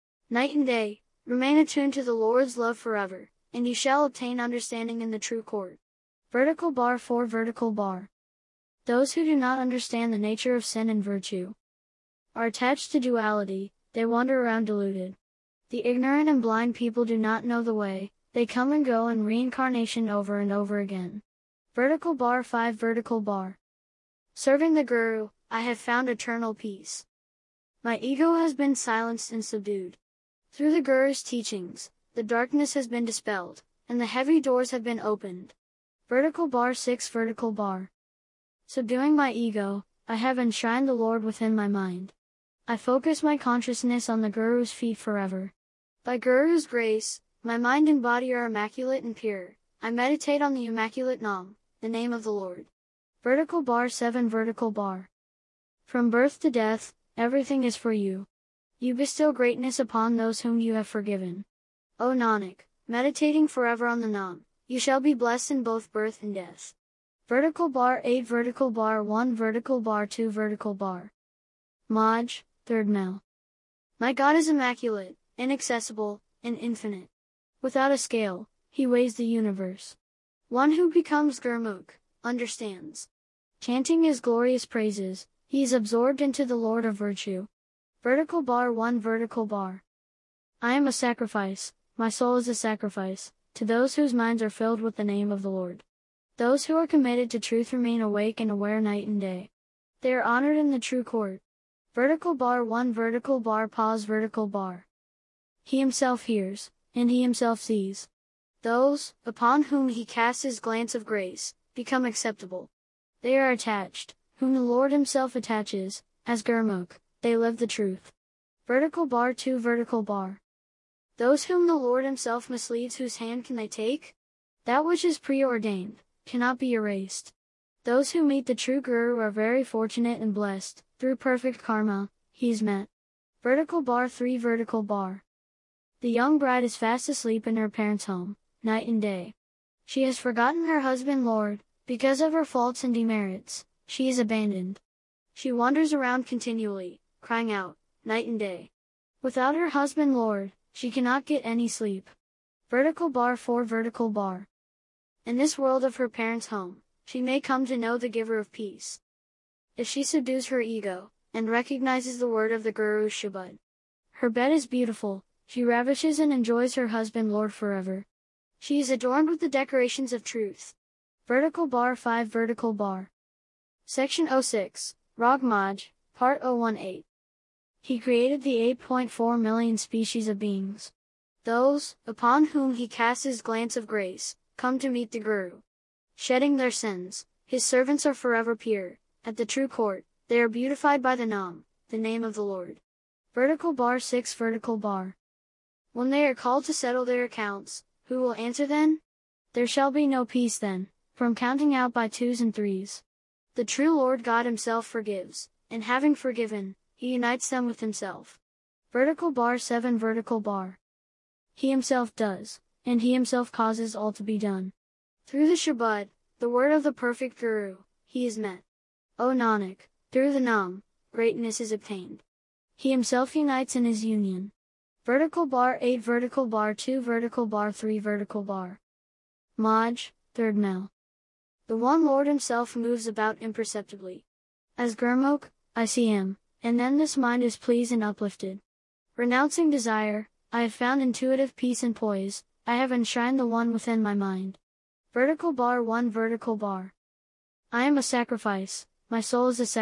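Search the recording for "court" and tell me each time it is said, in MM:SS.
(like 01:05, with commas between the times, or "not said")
00:05, 01:41, 03:09.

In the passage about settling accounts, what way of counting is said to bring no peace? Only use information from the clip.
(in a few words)
Twos and threes.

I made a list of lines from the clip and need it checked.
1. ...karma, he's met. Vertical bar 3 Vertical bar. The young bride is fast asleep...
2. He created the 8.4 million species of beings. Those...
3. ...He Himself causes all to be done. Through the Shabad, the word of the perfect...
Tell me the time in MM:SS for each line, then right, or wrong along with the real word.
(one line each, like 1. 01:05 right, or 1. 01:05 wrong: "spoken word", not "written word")
1. 02:11 right
2. 02:57 right
3. 03:33 right.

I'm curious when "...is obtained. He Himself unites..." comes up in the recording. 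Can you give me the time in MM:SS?
03:41.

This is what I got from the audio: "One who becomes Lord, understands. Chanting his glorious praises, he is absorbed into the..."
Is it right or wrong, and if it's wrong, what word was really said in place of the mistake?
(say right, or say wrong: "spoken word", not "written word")
wrong: "Gurmukh", not "Lord".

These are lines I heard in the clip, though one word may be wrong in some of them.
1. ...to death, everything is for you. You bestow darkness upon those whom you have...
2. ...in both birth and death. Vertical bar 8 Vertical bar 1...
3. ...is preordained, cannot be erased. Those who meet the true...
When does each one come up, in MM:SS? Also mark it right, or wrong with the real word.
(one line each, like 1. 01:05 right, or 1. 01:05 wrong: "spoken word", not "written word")
1. 00:56 wrong: "greatness", not "darkness"
2. 01:05 right
3. 02:05 right.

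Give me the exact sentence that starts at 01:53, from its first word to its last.
They are attached, whom the Lord himself attaches, as Gurmukh, they live the truth.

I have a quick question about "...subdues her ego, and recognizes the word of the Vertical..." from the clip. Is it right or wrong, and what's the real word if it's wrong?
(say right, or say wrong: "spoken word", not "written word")
wrong: "Guru", not "Vertical".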